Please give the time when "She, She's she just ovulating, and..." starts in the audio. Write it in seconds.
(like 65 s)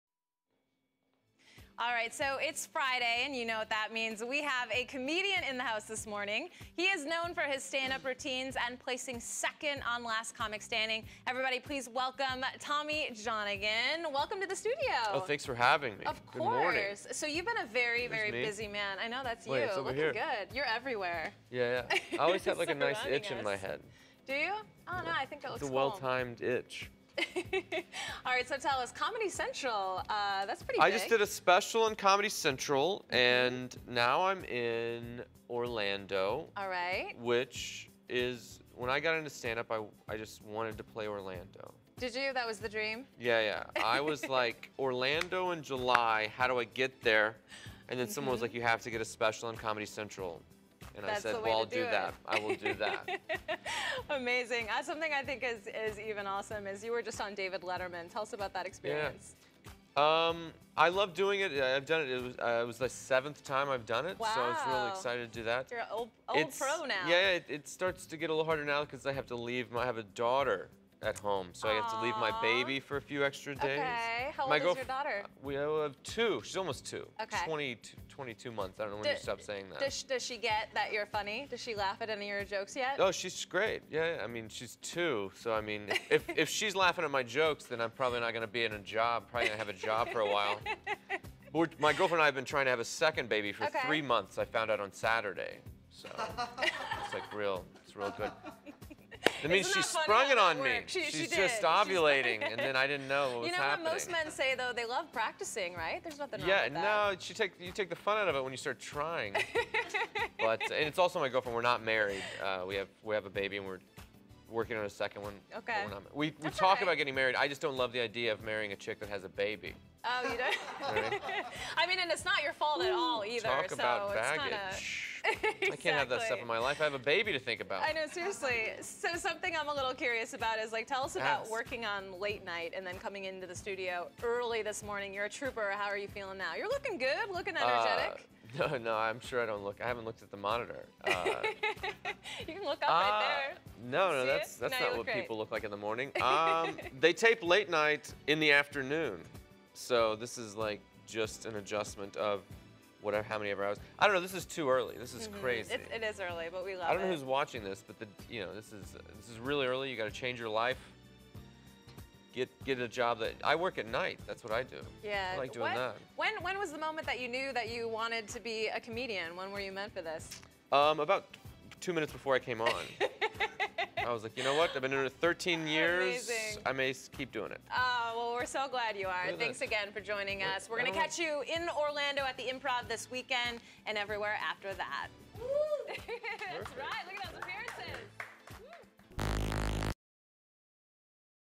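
100 s.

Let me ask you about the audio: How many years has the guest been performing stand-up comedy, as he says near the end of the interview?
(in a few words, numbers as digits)
13.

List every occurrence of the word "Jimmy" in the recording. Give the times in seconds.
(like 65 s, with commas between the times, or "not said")
not said.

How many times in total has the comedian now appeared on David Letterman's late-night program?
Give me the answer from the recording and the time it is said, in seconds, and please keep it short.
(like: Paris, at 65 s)
7, at 62 s.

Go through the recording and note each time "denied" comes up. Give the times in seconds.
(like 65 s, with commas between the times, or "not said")
not said.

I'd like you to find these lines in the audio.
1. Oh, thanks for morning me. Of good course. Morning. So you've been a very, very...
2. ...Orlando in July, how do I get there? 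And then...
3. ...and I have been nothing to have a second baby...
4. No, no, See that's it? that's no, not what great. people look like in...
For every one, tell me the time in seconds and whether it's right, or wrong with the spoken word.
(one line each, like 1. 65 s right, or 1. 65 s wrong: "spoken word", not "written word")
1. 15 s wrong: "having", not "morning"
2. 44 s right
3. 92 s wrong: "trying", not "nothing"
4. 143 s right.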